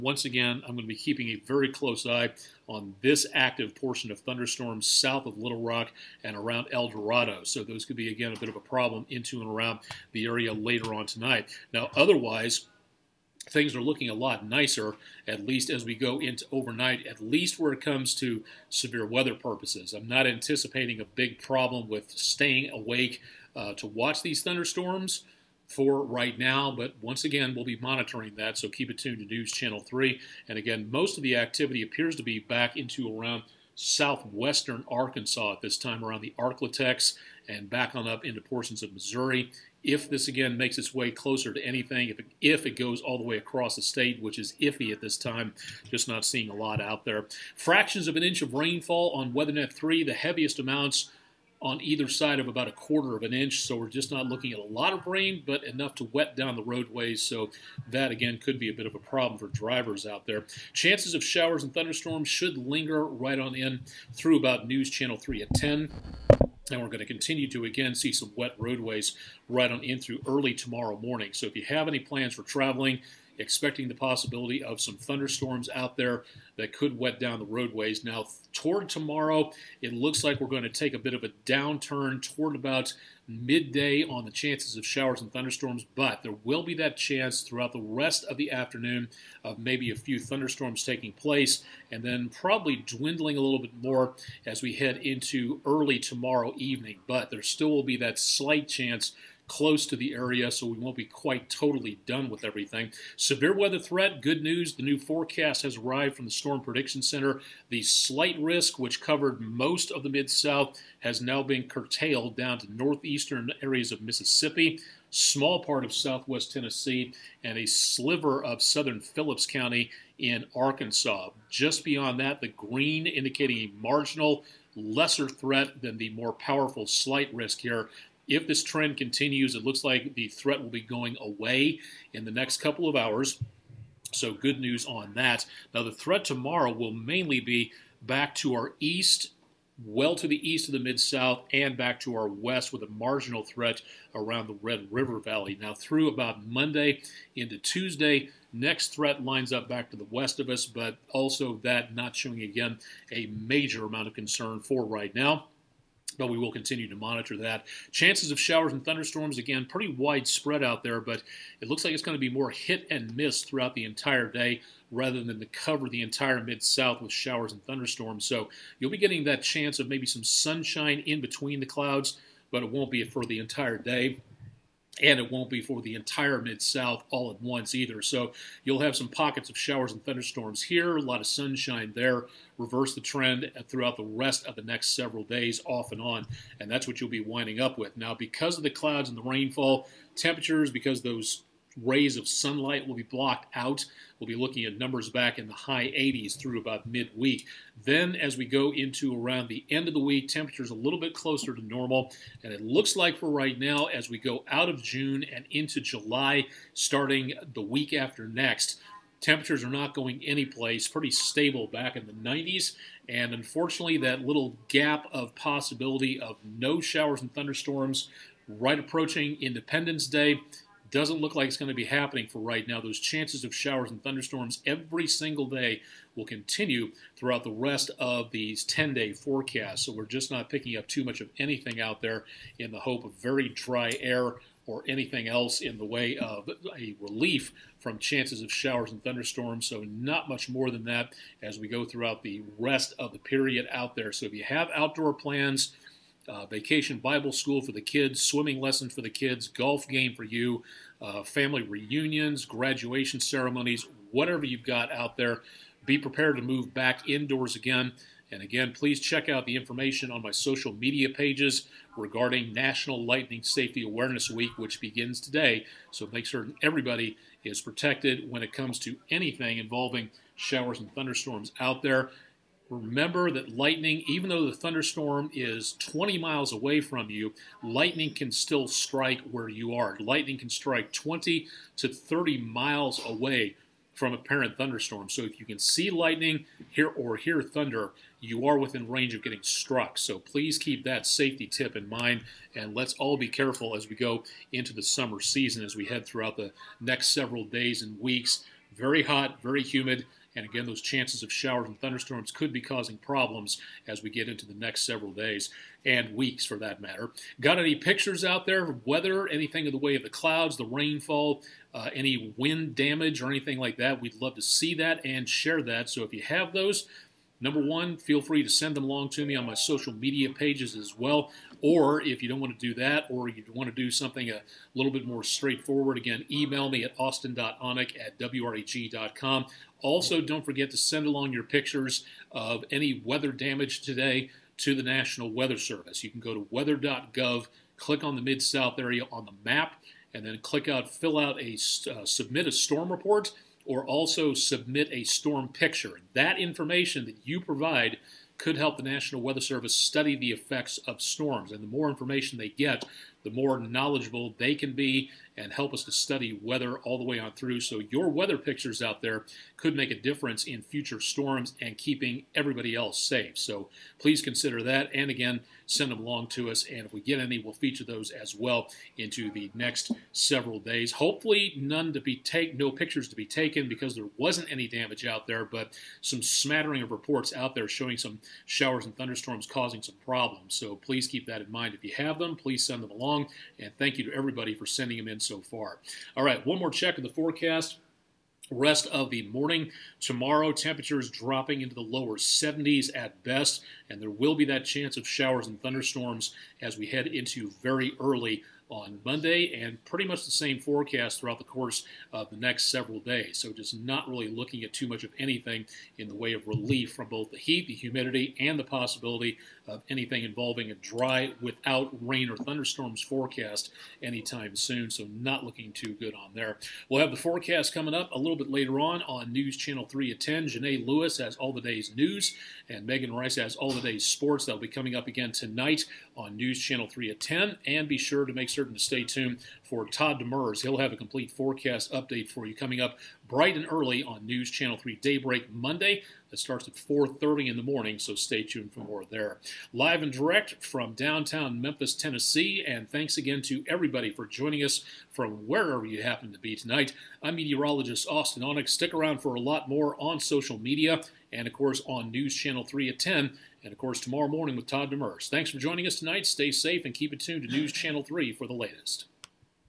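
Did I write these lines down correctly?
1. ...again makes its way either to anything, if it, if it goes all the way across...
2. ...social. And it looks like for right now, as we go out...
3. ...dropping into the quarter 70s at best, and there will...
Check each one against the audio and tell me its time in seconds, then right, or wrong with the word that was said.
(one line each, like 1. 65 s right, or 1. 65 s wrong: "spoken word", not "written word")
1. 40 s wrong: "closer", not "either"
2. 201 s wrong: "normal", not "social"
3. 391 s wrong: "lower", not "quarter".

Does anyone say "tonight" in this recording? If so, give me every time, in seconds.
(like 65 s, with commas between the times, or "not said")
11 s, 425 s, 446 s, 455 s.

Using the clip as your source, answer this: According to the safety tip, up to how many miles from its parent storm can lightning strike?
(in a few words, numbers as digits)
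20 to 30 miles.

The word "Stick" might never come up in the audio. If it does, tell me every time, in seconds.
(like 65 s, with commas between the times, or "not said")
448 s.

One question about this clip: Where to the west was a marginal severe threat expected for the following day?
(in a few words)
Red River Valley.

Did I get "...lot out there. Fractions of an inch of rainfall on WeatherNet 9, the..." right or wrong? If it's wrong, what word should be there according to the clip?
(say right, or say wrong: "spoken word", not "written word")
wrong: "3", not "9".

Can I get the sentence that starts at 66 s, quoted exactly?
And we're going to continue to again see some wet roadways right on in through early tomorrow morning.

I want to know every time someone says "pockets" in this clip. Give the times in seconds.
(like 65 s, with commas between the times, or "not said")
179 s.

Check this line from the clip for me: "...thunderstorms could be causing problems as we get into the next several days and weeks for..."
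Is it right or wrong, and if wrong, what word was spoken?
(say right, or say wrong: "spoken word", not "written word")
right.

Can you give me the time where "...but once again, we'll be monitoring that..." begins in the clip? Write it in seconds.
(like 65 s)
26 s.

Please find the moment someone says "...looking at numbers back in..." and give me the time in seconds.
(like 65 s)
194 s.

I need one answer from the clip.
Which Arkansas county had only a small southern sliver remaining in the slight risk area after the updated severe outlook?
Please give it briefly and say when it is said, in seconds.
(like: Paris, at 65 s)
Phillips County, at 118 s.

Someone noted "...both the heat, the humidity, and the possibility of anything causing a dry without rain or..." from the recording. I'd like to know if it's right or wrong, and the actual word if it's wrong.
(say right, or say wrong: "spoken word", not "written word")
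wrong: "involving", not "causing".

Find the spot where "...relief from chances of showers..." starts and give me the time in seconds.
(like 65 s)
236 s.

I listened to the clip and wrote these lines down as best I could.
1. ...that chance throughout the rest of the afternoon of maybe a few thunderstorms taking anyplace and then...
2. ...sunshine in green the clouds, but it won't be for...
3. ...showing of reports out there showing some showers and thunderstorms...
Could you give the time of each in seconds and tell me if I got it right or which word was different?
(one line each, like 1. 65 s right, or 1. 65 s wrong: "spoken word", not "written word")
1. 86 s wrong: "place", not "anyplace"
2. 170 s wrong: "between", not "green"
3. 376 s wrong: "smattering", not "showing".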